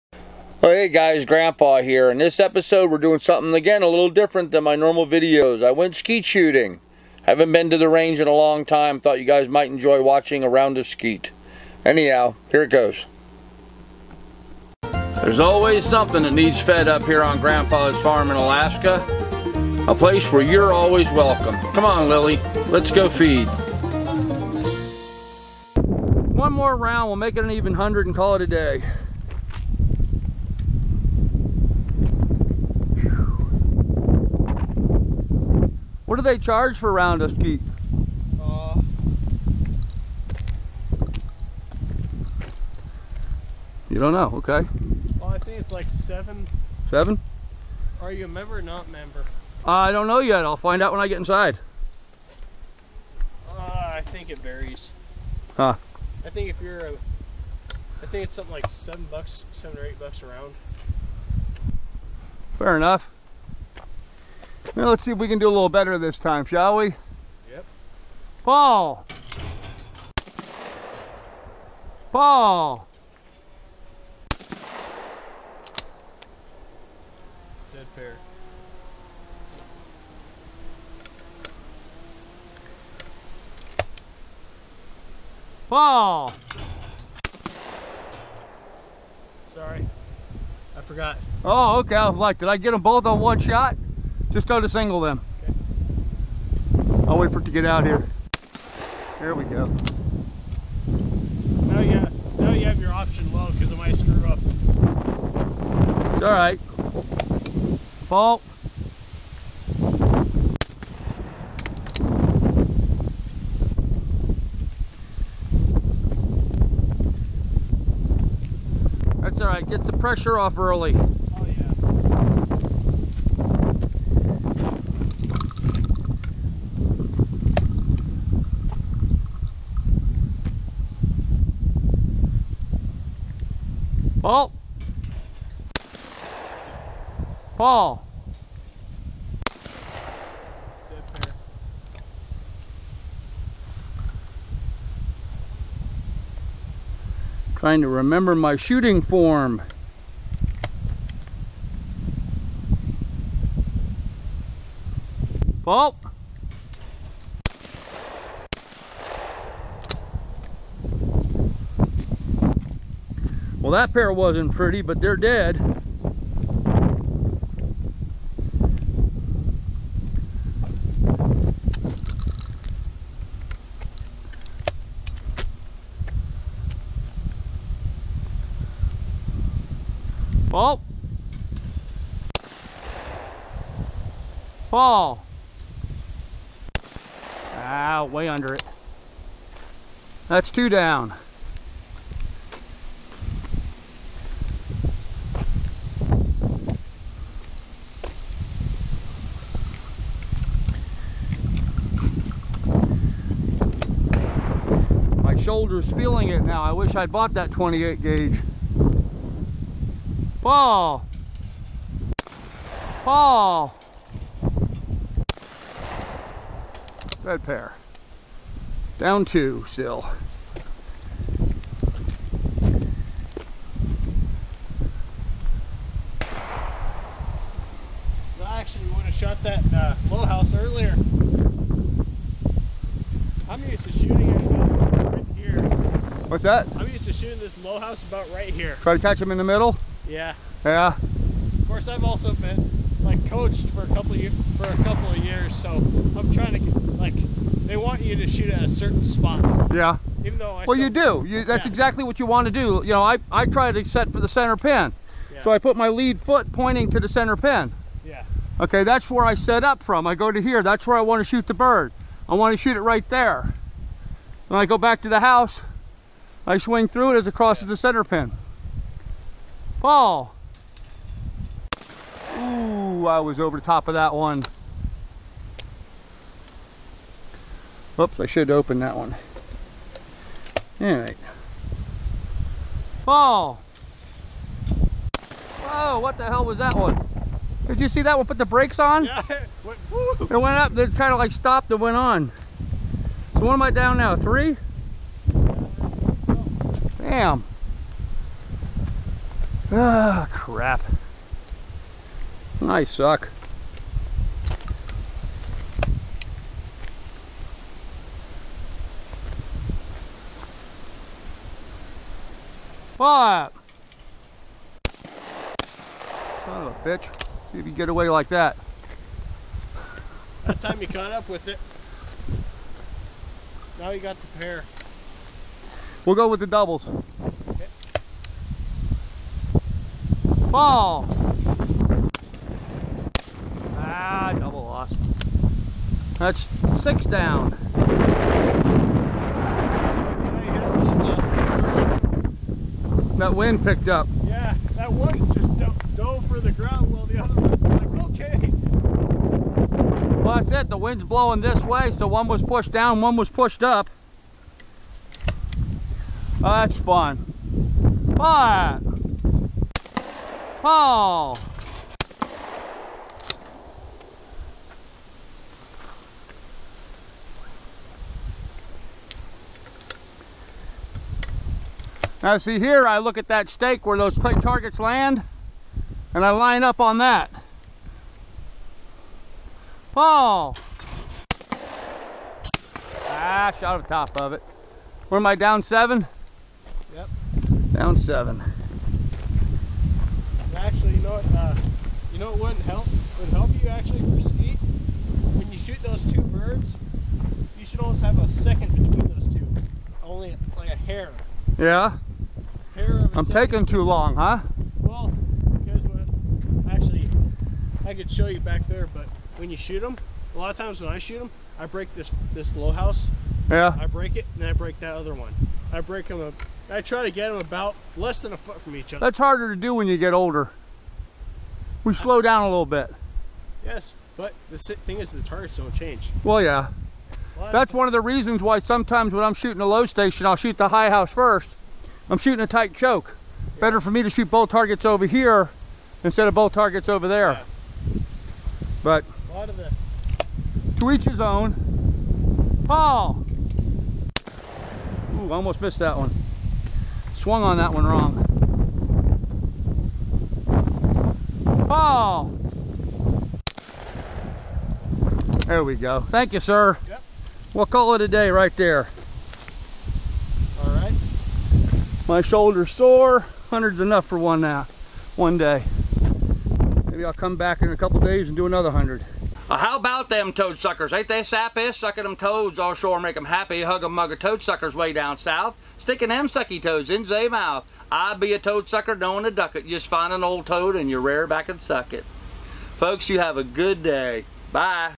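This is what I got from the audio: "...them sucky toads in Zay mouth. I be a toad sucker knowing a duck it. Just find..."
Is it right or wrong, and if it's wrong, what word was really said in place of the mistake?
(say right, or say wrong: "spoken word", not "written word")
right.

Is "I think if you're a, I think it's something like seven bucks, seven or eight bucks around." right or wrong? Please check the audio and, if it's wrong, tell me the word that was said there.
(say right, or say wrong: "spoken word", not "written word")
right.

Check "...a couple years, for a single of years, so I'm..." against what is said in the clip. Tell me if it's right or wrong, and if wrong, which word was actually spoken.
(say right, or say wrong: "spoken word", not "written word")
wrong: "couple", not "single".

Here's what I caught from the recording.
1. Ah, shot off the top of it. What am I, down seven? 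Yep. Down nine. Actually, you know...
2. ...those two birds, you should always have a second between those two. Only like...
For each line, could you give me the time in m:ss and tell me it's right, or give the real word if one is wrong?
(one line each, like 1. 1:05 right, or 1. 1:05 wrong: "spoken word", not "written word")
1. 6:23 wrong: "seven", not "nine"
2. 6:35 right.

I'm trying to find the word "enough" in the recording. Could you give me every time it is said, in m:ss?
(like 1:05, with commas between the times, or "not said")
1:02, 7:43.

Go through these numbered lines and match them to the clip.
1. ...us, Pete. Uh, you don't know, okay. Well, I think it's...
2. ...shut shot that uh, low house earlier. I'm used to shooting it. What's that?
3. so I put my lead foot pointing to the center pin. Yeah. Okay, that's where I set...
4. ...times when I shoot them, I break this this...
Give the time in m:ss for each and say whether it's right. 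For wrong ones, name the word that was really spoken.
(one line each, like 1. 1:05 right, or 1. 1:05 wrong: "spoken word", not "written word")
1. 0:37 right
2. 3:49 right
3. 4:15 right
4. 6:50 right.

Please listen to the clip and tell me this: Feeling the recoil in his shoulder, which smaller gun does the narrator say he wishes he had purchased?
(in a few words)
28 gauge.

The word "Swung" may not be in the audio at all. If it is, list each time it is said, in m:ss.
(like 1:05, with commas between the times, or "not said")
7:27.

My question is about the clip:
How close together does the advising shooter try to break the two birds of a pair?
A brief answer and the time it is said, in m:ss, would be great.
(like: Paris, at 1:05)
Less than a foot, at 6:57.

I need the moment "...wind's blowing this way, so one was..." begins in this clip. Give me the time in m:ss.
5:50.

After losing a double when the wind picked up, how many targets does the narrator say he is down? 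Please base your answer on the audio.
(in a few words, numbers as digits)
6.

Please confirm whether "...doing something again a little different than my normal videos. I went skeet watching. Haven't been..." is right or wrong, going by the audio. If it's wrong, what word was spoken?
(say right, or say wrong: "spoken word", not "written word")
wrong: "shooting", not "watching".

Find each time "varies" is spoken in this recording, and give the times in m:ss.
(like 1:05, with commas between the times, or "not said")
0:54.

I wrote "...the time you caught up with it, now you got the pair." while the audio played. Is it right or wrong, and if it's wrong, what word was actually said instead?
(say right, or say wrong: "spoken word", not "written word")
right.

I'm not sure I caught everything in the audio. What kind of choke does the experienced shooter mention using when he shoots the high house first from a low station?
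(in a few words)
A tight choke.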